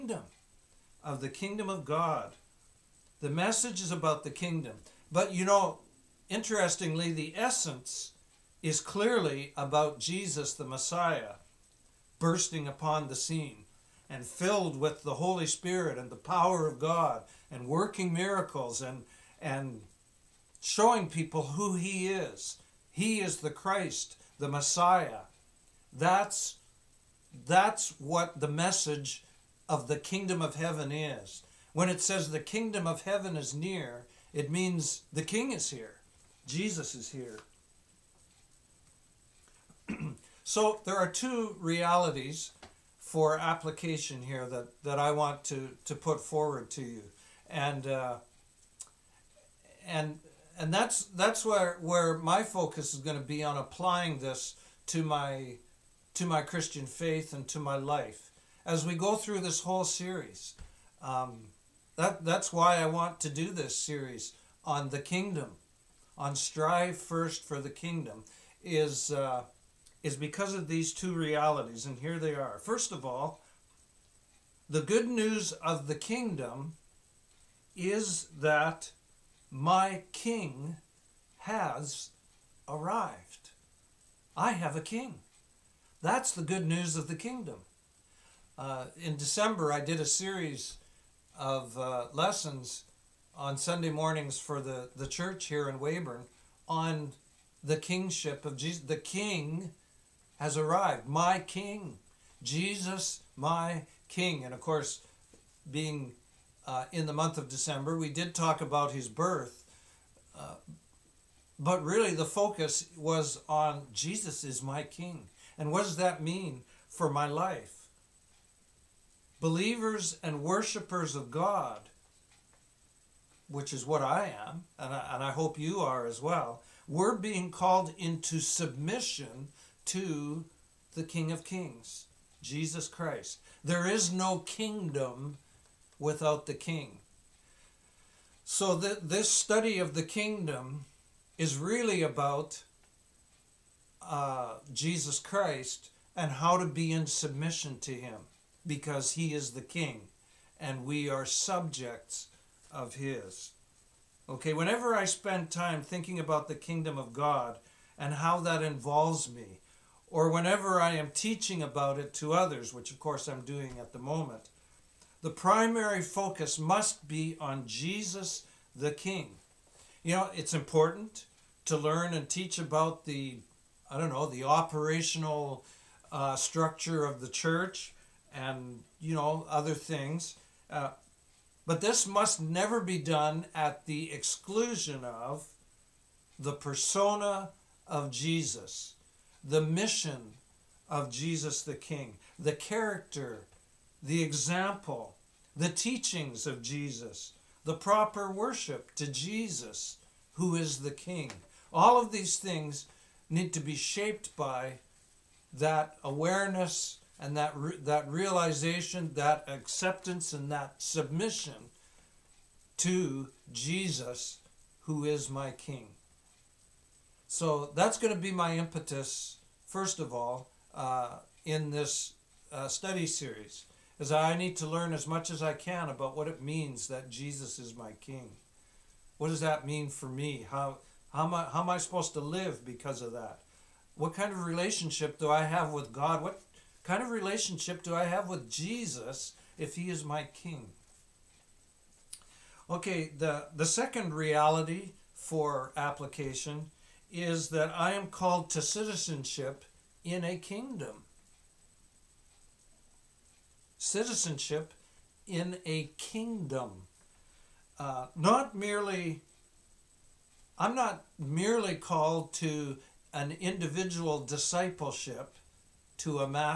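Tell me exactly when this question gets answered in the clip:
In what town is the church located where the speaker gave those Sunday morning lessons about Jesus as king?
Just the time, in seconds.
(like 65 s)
95 s.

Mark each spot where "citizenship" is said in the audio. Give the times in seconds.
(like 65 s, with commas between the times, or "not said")
248 s, 253 s.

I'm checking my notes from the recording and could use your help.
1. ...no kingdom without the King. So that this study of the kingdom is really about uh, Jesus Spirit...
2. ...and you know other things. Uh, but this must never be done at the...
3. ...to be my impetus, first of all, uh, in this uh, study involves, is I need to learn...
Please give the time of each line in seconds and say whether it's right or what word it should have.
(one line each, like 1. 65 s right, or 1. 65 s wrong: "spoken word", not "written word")
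1. 134 s wrong: "Christ", not "Spirit"
2. 178 s right
3. 218 s wrong: "series", not "involves".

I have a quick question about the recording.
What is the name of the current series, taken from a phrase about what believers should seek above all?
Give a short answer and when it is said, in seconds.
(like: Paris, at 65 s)
Strive first for the kingdom, at 66 s.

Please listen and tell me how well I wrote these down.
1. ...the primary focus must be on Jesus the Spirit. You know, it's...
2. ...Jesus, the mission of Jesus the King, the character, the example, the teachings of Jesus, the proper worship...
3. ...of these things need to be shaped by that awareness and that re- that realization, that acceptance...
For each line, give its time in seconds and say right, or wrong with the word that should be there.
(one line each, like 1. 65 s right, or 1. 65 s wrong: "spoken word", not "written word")
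1. 165 s wrong: "King", not "Spirit"
2. 188 s right
3. 202 s right.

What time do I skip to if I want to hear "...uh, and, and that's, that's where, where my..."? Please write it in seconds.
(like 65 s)
47 s.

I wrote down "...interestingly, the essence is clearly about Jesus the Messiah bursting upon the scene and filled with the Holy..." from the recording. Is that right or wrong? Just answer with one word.
right.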